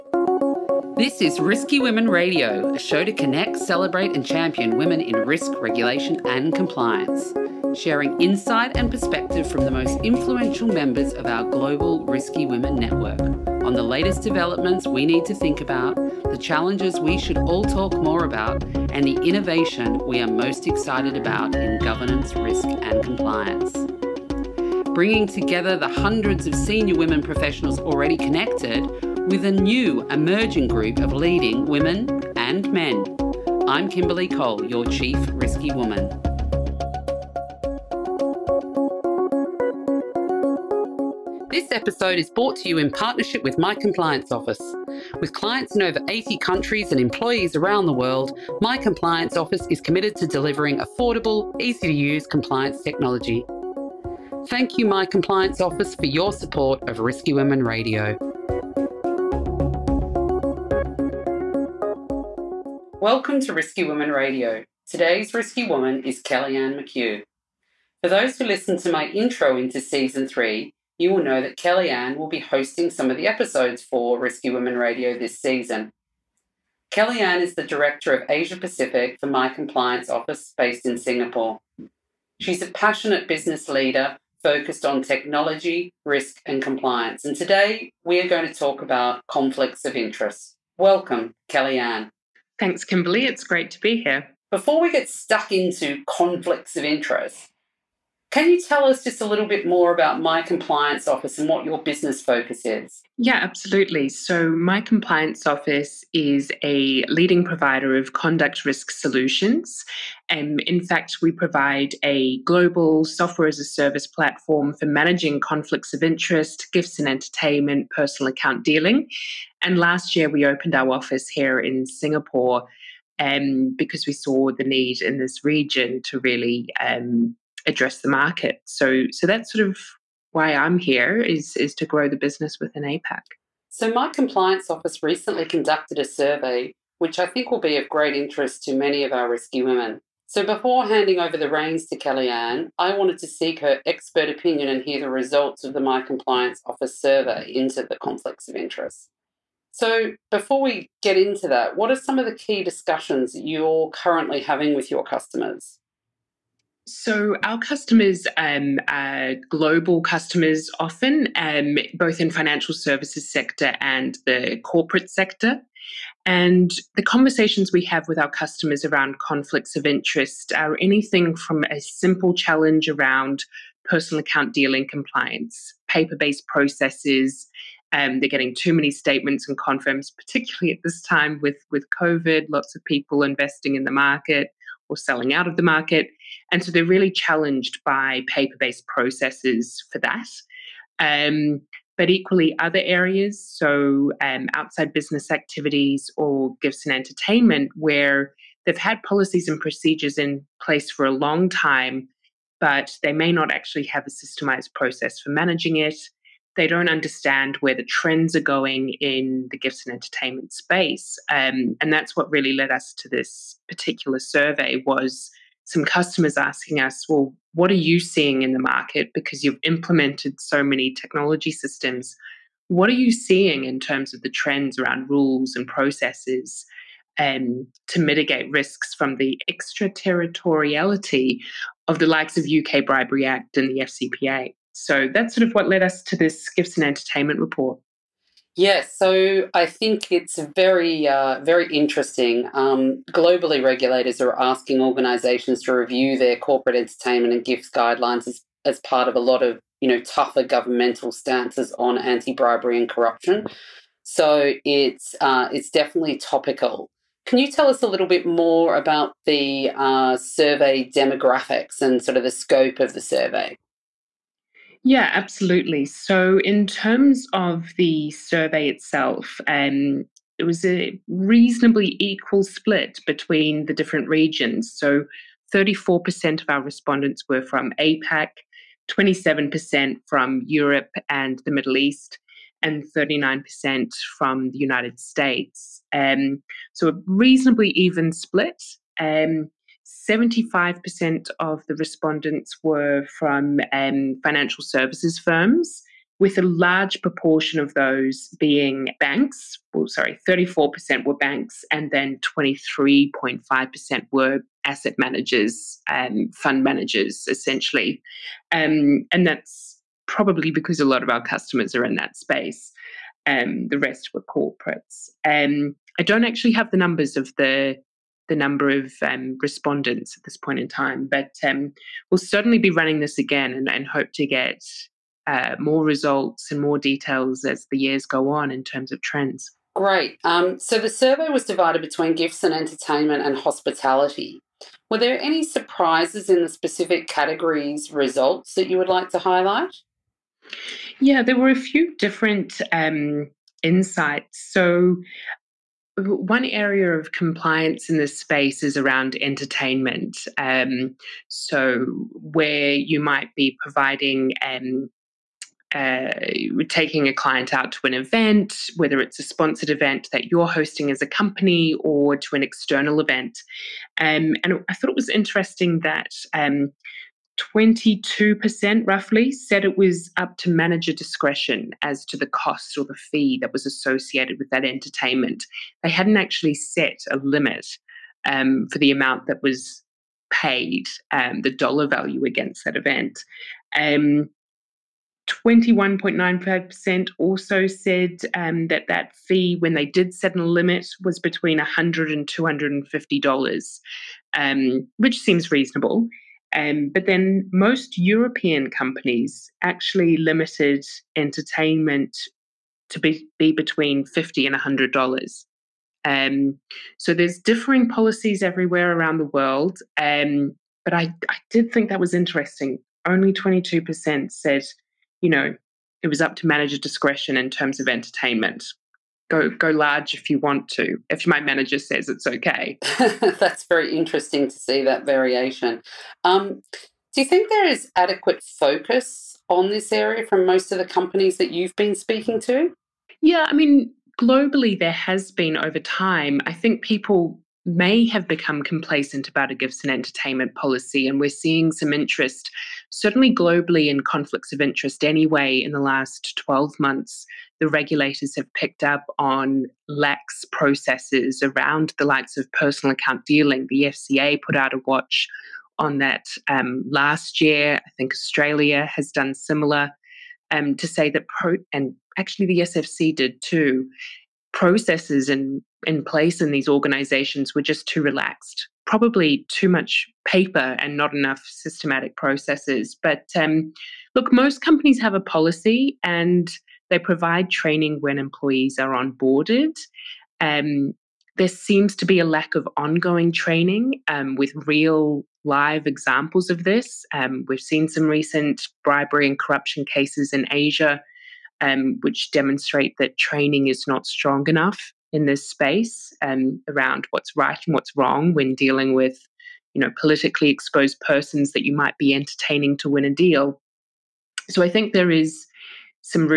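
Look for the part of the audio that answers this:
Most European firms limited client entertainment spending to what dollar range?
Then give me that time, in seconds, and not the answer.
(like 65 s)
404 s.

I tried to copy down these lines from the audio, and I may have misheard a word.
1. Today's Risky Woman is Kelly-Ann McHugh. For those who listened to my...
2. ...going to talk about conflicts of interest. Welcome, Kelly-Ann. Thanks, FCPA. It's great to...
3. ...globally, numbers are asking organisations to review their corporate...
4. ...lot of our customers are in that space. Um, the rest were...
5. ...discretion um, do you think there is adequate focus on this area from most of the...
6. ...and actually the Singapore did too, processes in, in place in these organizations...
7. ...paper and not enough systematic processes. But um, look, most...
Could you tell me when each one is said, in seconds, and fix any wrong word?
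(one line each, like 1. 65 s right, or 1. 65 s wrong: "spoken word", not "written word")
1. 64 s right
2. 88 s wrong: "Kimberly", not "FCPA"
3. 243 s wrong: "regulators", not "numbers"
4. 310 s right
5. 425 s wrong: "variation", not "discretion"
6. 461 s wrong: "SFC", not "Singapore"
7. 470 s right.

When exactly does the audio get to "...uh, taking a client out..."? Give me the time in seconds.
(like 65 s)
355 s.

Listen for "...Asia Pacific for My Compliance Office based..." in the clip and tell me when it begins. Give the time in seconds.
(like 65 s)
78 s.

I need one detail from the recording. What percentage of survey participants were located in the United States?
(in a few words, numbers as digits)
39%.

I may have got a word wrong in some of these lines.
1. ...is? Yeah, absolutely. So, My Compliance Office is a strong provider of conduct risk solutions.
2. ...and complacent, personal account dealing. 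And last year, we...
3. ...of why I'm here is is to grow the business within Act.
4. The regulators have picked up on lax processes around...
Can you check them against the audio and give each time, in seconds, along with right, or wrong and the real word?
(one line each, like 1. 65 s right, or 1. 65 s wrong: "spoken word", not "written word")
1. 102 s wrong: "leading", not "strong"
2. 116 s wrong: "entertainment", not "complacent"
3. 129 s wrong: "APAC", not "Act"
4. 447 s right.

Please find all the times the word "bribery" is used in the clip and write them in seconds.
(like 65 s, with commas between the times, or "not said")
232 s, 251 s, 488 s.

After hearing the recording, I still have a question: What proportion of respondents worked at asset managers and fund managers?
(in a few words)
23.5%.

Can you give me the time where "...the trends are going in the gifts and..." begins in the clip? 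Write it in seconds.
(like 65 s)
207 s.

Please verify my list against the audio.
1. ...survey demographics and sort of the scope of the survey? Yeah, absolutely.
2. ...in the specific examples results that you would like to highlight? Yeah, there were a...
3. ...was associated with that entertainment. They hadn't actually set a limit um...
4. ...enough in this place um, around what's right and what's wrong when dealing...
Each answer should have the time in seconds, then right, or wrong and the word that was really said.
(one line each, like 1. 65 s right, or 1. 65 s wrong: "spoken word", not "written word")
1. 260 s right
2. 336 s wrong: "categories", not "examples"
3. 373 s right
4. 494 s wrong: "space", not "place".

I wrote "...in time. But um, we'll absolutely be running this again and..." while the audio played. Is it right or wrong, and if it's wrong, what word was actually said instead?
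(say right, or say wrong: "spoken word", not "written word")
wrong: "certainly", not "absolutely".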